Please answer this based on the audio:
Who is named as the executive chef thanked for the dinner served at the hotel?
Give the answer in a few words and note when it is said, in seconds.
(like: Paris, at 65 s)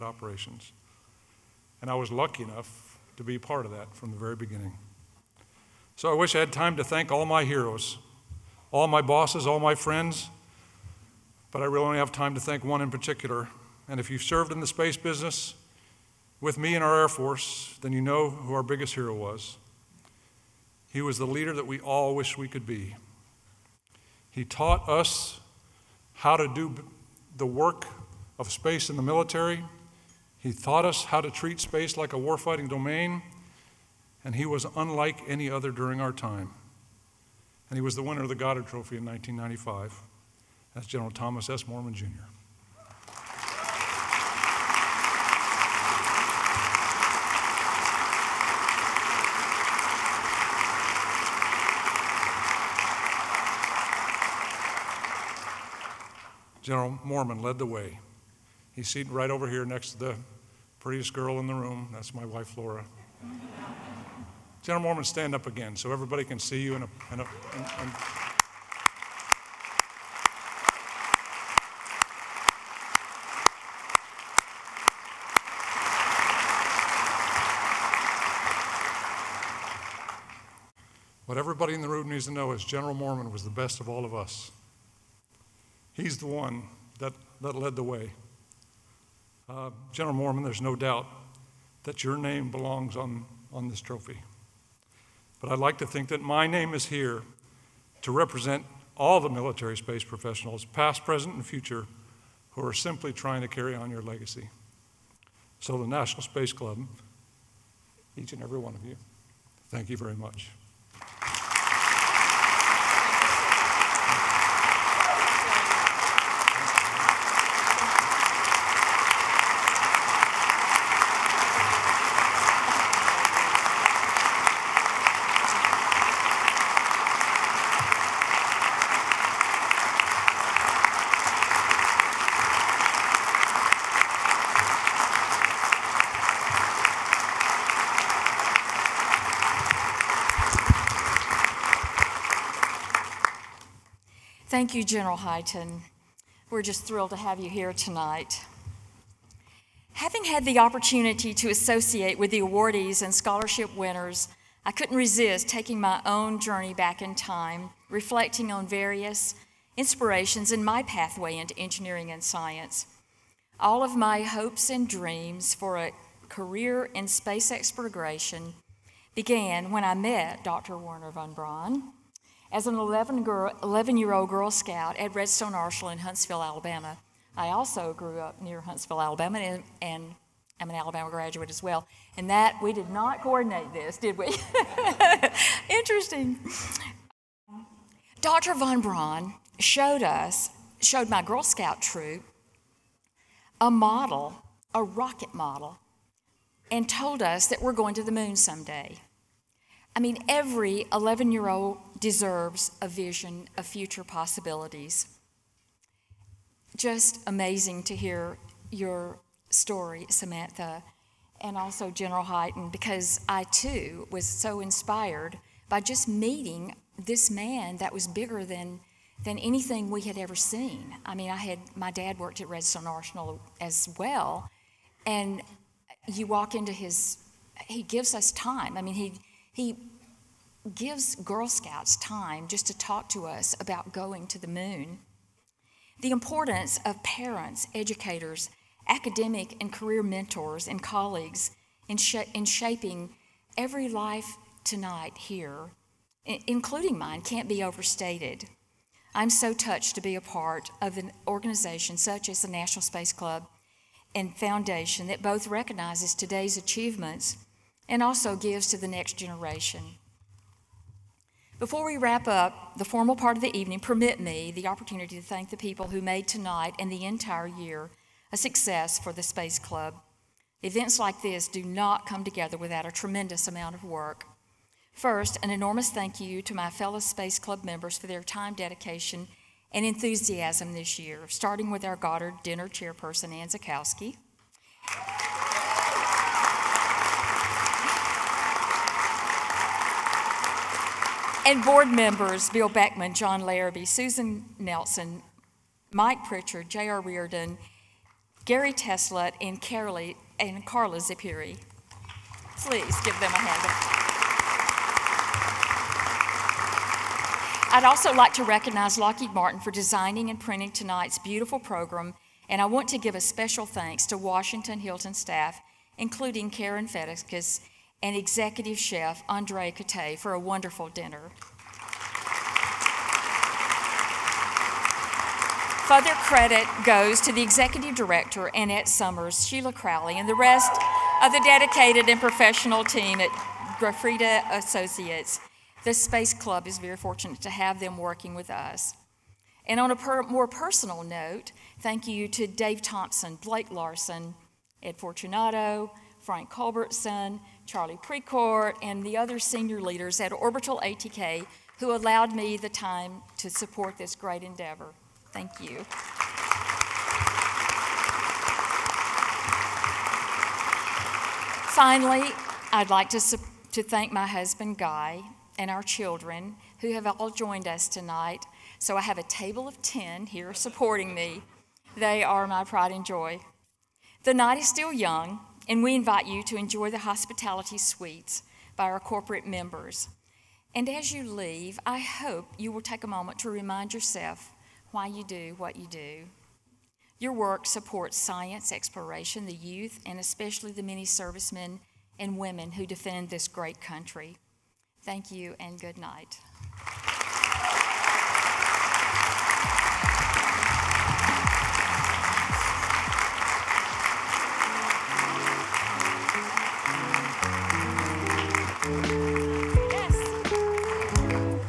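Andre Cote, at 319 s.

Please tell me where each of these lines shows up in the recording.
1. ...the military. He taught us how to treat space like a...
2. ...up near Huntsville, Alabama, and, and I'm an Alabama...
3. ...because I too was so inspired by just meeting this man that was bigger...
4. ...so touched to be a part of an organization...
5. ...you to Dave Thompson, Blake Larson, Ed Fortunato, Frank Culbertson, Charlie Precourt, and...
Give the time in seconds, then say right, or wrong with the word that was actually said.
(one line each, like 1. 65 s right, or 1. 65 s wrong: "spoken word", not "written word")
1. 28 s right
2. 178 s right
3. 212 s right
4. 249 s right
5. 342 s right.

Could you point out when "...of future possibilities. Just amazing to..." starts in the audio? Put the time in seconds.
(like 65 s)
203 s.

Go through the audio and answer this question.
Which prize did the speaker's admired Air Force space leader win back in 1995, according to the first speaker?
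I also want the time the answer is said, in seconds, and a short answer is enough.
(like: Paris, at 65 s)
Goddard Trophy, at 38 s.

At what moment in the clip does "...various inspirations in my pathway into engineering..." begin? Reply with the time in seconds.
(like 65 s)
158 s.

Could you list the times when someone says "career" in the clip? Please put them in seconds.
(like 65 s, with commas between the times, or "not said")
166 s, 239 s.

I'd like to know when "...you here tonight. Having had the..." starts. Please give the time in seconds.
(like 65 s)
147 s.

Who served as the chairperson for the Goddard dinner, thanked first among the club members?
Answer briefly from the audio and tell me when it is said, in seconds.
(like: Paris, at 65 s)
Ann Zakowski, at 283 s.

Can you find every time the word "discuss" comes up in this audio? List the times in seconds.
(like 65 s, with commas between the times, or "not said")
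not said.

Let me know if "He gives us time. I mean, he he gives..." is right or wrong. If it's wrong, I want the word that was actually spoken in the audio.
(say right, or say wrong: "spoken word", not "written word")
right.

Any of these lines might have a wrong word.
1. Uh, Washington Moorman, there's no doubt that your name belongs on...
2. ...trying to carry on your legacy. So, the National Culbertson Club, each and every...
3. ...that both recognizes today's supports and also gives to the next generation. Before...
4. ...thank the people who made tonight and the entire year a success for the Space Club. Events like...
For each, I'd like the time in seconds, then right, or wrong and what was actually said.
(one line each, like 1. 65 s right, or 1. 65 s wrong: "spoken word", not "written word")
1. 89 s wrong: "General", not "Washington"
2. 103 s wrong: "Space", not "Culbertson"
3. 255 s wrong: "achievements", not "supports"
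4. 265 s right.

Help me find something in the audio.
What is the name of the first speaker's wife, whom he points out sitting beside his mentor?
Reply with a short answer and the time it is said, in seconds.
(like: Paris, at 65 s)
Laura, at 62 s.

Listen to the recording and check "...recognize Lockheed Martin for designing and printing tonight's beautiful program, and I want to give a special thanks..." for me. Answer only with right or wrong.
right.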